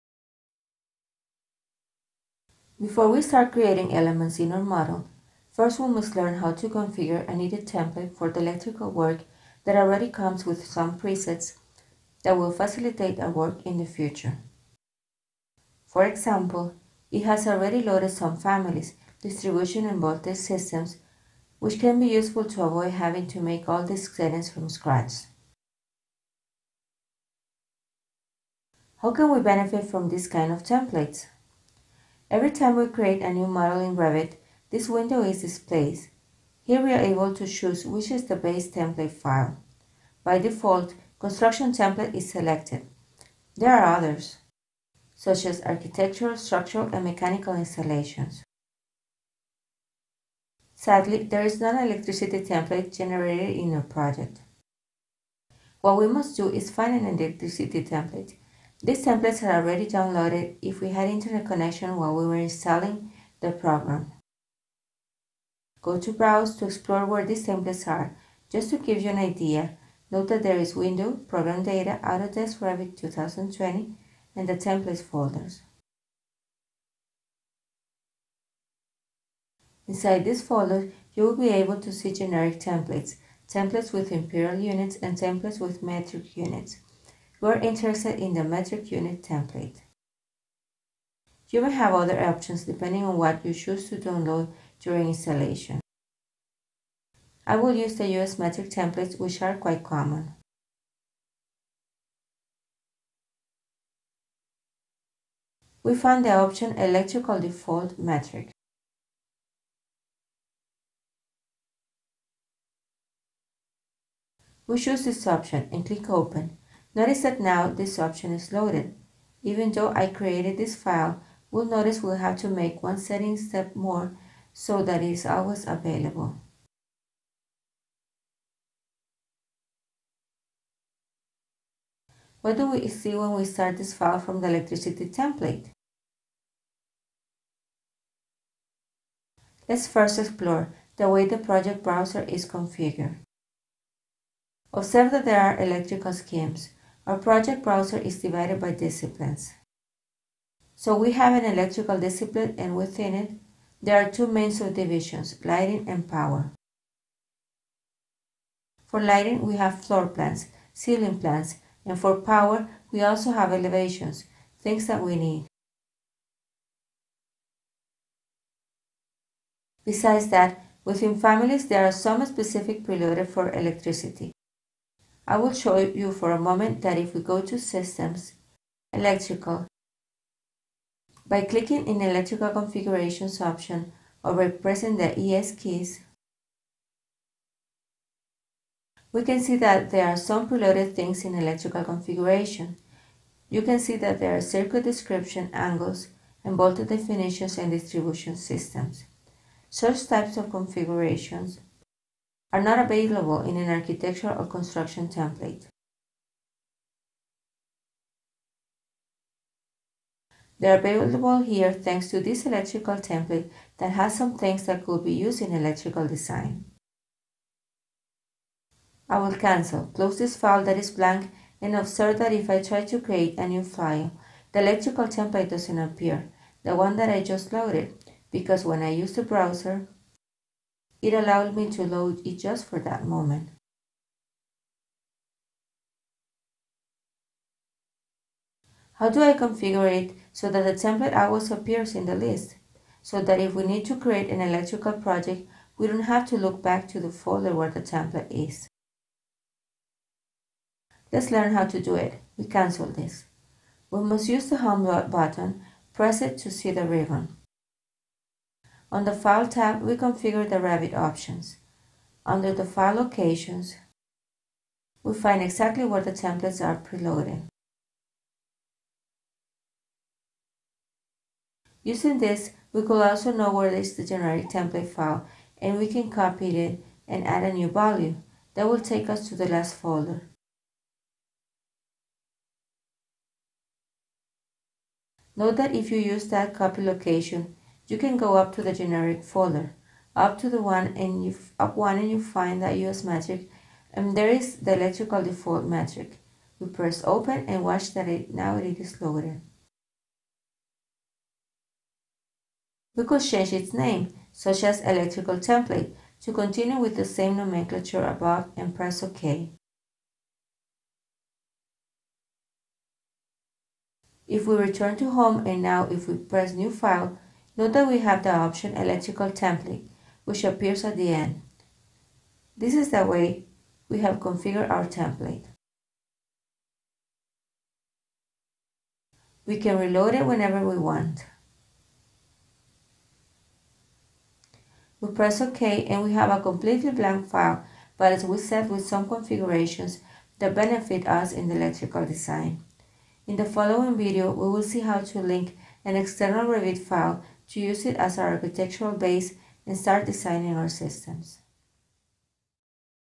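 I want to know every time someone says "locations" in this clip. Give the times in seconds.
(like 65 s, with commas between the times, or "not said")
262 s, 286 s.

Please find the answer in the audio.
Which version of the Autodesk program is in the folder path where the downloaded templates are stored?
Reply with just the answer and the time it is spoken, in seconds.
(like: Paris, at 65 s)
Revit 2020, at 72 s.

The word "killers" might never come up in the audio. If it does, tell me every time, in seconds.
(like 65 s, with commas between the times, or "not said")
not said.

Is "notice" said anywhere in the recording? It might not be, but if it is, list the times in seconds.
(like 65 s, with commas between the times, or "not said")
116 s, 121 s.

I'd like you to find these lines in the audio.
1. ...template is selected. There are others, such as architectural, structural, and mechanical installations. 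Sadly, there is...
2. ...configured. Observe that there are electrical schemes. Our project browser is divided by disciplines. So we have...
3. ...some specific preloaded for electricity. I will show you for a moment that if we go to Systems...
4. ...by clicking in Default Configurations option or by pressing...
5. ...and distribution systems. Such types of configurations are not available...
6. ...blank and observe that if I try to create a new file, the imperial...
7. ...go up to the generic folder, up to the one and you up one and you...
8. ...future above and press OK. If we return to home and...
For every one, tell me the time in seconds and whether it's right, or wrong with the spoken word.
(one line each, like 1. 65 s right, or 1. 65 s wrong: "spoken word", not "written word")
1. 41 s right
2. 142 s right
3. 171 s right
4. 181 s wrong: "Electrical", not "Default"
5. 197 s right
6. 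220 s wrong: "electrical", not "imperial"
7. 288 s right
8. 307 s wrong: "nomenclature", not "future".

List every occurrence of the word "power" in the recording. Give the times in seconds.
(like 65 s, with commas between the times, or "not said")
156 s, 162 s.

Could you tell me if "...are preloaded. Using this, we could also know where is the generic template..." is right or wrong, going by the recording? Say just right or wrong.
right.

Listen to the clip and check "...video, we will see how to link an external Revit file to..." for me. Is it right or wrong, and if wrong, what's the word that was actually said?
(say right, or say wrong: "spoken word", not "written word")
right.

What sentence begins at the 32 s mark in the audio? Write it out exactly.
Every time we create a new model in Revit, this window is displayed.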